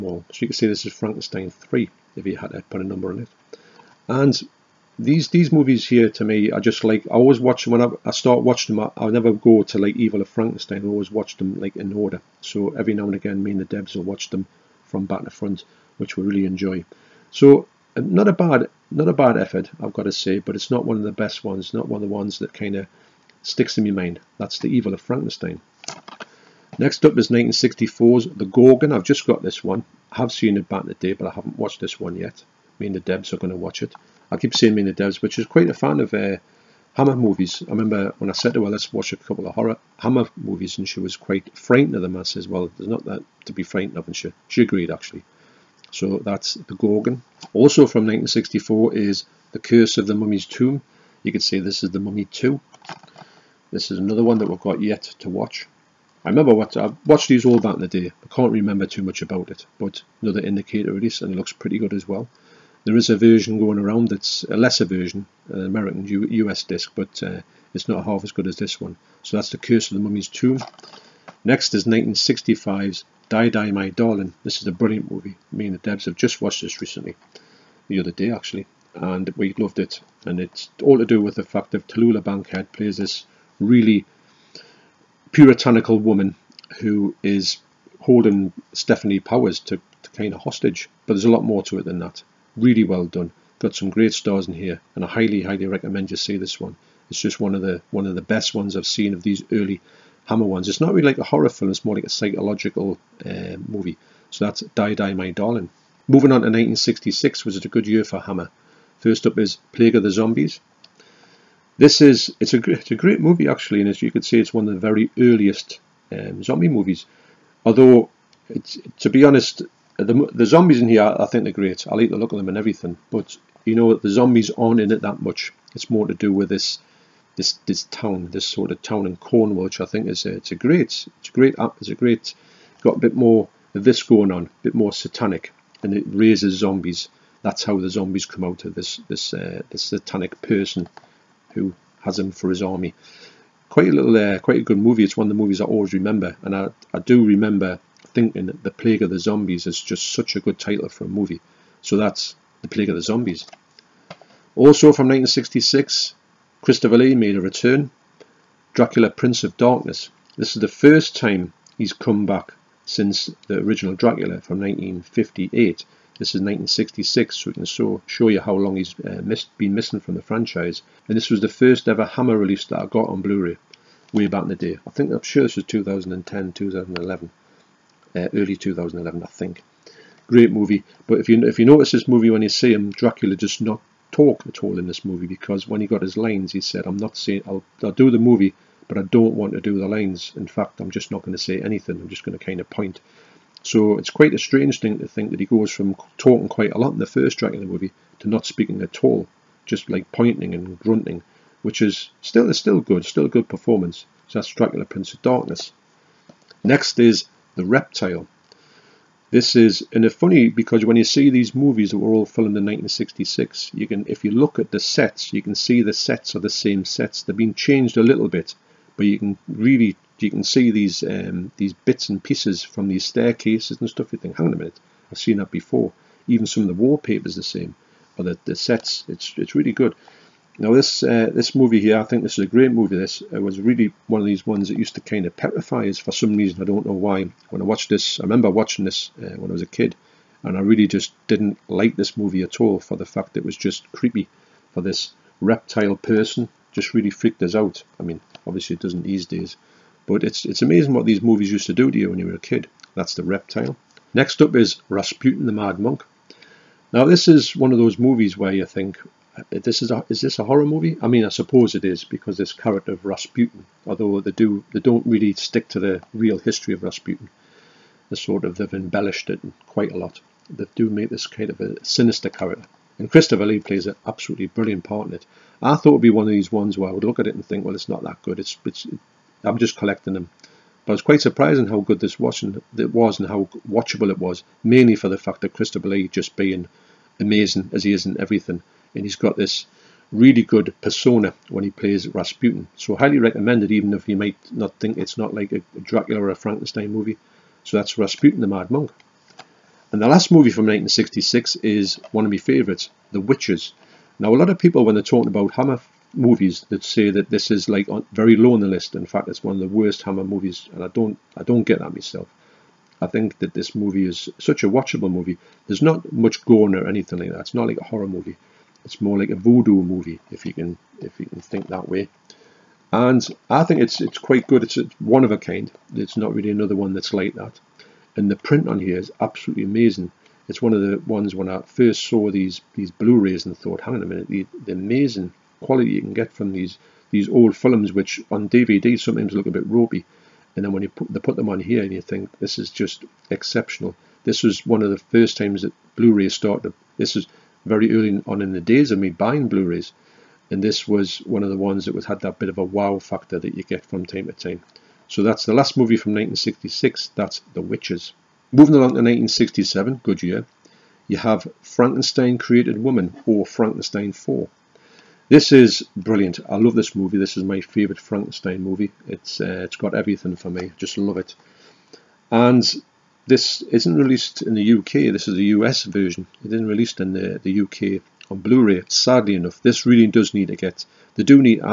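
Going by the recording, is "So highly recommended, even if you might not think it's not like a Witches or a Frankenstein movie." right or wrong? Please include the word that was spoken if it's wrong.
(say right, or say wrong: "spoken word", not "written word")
wrong: "Dracula", not "Witches".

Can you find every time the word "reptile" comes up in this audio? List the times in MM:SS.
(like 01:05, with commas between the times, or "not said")
03:27, 04:05, 04:13.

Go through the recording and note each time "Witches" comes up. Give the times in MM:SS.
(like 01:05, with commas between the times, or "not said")
05:03, 05:57.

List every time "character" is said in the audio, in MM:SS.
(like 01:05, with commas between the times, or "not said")
04:22, 04:32.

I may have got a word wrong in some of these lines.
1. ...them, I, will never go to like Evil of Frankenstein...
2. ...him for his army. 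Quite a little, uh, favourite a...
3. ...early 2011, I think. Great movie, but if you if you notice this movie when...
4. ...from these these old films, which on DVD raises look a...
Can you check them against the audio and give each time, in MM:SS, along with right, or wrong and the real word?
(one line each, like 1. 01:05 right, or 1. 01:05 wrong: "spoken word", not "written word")
1. 00:08 right
2. 02:22 wrong: "quite", not "favourite"
3. 02:58 right
4. 05:36 wrong: "sometimes", not "raises".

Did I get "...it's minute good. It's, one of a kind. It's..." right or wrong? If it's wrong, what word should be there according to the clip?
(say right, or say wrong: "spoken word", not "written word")
wrong: "quite", not "minute".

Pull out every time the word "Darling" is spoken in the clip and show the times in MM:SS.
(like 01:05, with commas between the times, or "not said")
01:13, 01:45.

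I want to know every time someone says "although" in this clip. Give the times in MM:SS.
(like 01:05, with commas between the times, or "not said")
01:57, 04:23.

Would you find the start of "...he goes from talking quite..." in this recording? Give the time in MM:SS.
03:15.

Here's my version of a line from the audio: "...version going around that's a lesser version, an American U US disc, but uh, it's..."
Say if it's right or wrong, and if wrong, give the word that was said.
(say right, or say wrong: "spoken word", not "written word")
right.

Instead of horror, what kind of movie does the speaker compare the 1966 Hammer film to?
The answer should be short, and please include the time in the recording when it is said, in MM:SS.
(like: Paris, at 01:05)
A voodoo movie, at 05:19.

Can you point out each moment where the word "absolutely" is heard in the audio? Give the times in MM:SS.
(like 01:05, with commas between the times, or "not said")
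04:34, 05:29.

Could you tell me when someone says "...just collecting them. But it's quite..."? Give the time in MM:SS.
04:39.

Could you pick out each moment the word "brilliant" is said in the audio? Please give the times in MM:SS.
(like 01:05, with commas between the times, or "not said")
01:14, 04:34, 06:05.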